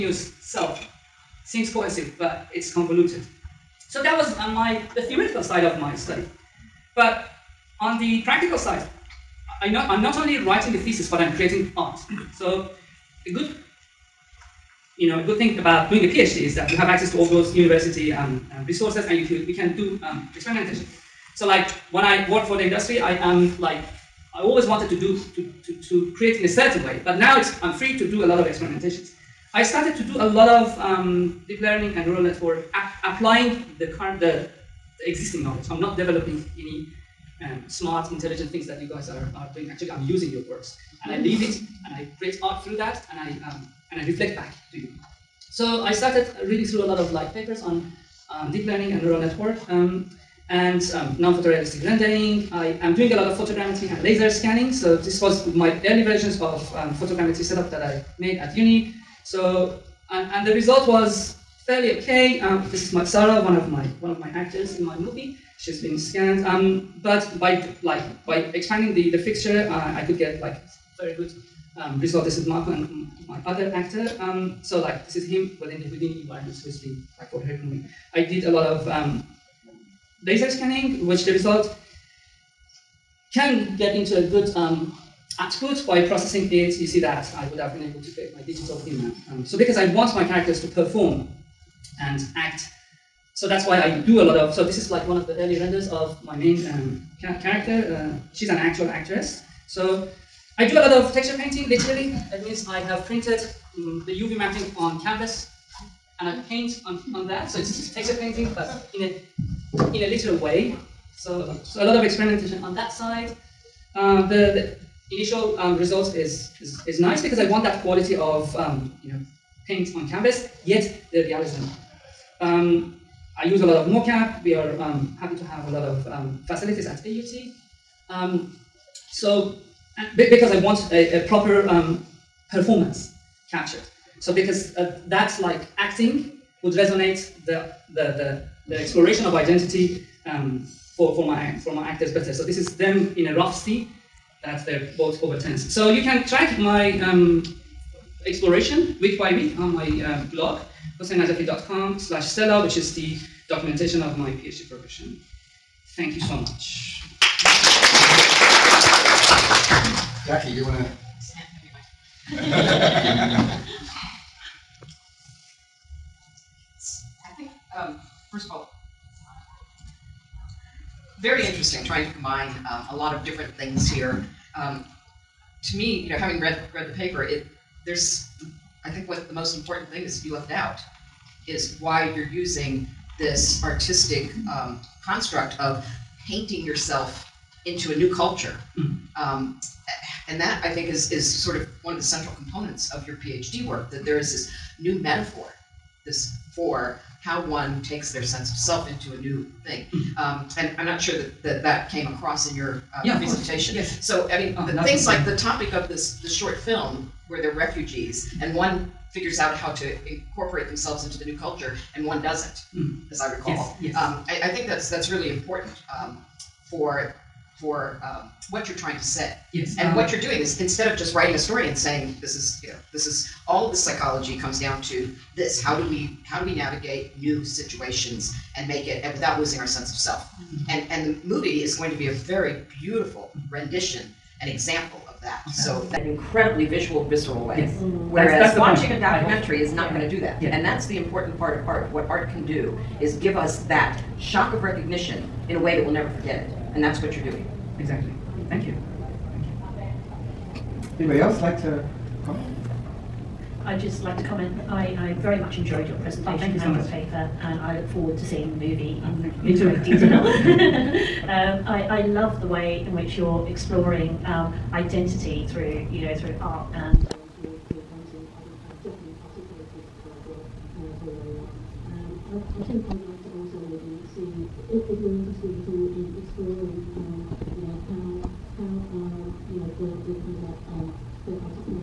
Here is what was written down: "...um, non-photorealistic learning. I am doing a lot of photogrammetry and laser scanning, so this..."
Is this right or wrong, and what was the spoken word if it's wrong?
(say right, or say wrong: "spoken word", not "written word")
wrong: "rendering", not "learning".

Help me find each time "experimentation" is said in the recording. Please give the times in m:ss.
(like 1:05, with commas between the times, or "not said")
0:20, 0:28, 1:52.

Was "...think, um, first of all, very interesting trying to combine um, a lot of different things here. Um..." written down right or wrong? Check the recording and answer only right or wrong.
right.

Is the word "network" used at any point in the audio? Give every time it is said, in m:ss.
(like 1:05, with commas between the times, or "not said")
0:32, 0:49.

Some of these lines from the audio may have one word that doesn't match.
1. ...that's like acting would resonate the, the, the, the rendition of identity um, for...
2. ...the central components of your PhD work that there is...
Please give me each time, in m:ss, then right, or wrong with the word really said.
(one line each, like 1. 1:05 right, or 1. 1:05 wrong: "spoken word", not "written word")
1. 2:15 wrong: "exploration", not "rendition"
2. 3:11 right.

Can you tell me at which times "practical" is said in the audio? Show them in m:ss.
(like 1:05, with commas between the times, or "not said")
0:08.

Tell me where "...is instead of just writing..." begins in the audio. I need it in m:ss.
3:40.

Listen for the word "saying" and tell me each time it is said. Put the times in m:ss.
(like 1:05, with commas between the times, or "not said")
3:41.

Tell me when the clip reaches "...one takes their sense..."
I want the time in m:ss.
3:17.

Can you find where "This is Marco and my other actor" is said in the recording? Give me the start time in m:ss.
1:12.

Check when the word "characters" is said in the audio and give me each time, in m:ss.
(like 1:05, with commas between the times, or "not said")
1:30, 1:37.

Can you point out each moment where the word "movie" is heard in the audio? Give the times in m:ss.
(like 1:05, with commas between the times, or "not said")
1:04, 1:17, 3:51, 4:18.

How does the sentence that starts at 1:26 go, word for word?
You see that I would have been able to create my digital human.